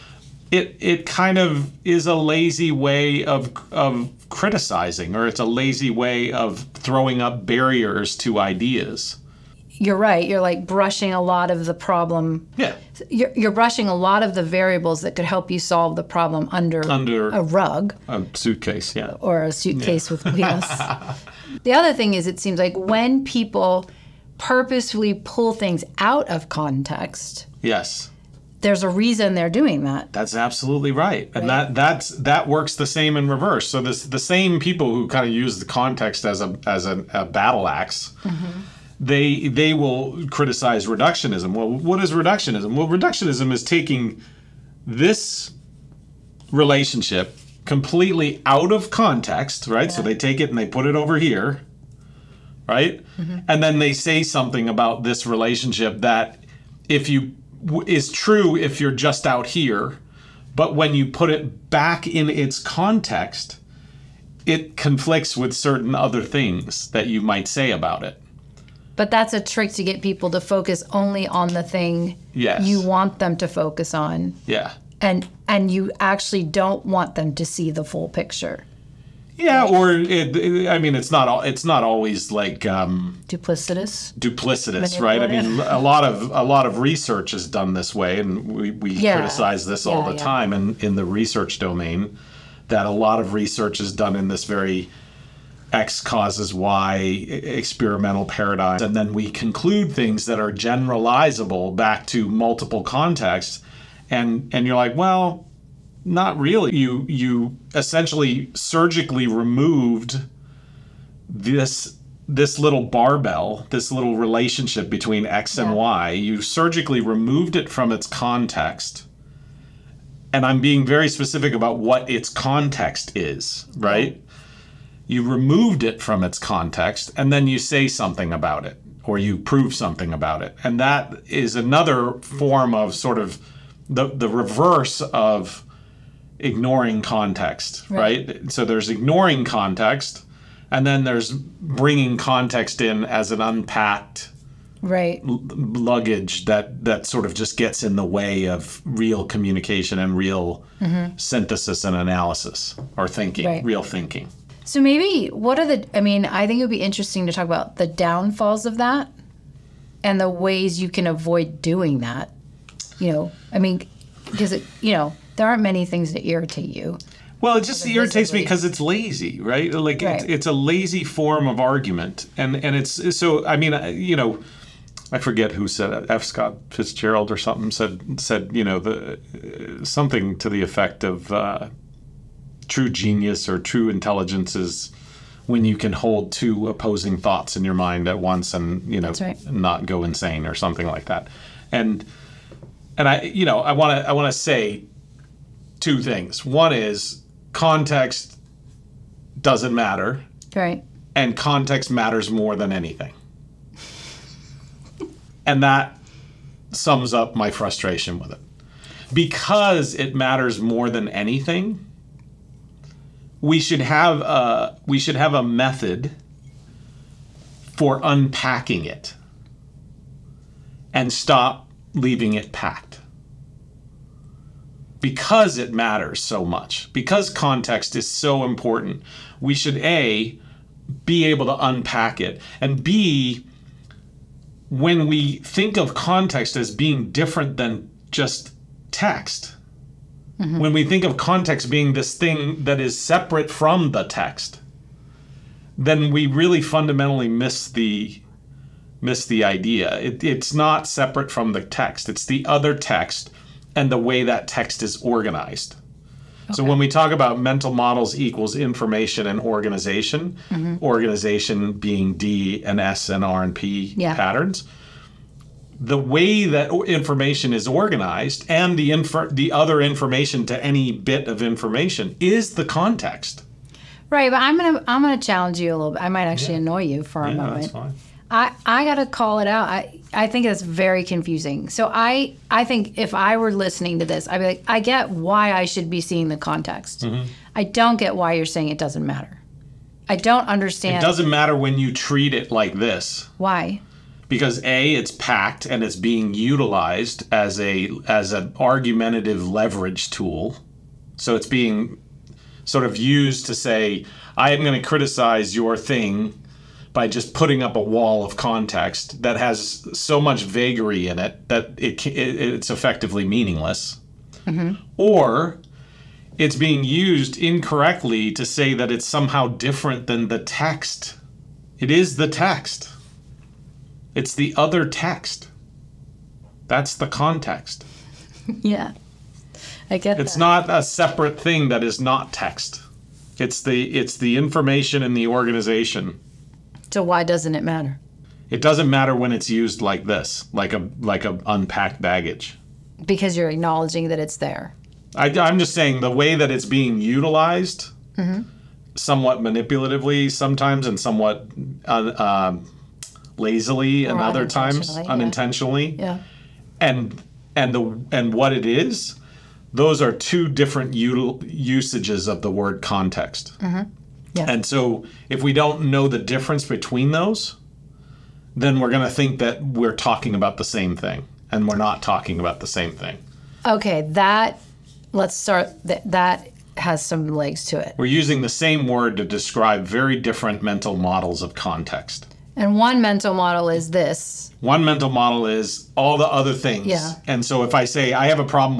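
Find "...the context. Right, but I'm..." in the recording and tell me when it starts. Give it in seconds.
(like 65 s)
272 s.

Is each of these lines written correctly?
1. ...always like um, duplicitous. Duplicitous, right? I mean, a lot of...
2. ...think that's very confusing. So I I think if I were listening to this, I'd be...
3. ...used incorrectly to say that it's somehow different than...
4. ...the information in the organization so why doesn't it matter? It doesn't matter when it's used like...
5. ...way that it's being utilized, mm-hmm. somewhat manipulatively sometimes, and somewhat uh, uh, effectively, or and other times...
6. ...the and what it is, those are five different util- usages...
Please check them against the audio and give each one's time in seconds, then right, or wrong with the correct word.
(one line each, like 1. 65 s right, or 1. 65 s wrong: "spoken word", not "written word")
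1. 81 s right
2. 280 s right
3. 316 s right
4. 334 s right
5. 346 s wrong: "lazily", not "effectively"
6. 357 s wrong: "two", not "five".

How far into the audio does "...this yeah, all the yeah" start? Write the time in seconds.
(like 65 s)
89 s.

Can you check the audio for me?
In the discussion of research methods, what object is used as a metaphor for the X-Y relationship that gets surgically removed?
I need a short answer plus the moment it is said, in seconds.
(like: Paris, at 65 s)
barbell, at 112 s.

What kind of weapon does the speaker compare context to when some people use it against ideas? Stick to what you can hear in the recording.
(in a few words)
battle ax.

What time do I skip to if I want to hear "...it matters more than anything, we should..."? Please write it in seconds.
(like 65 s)
209 s.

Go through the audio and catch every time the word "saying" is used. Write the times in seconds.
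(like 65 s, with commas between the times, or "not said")
288 s, 345 s.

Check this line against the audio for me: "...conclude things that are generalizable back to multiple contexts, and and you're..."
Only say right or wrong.
right.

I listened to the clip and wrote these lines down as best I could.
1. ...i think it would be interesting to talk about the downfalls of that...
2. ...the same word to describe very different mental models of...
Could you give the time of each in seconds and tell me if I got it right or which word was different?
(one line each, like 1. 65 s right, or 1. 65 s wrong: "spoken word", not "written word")
1. 156 s right
2. 378 s right.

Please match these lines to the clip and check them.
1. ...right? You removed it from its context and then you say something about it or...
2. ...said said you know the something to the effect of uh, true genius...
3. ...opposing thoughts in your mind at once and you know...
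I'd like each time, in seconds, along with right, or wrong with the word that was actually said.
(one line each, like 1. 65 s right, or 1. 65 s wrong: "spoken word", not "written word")
1. 123 s right
2. 177 s right
3. 186 s right.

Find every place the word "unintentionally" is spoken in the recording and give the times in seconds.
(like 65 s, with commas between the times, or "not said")
355 s.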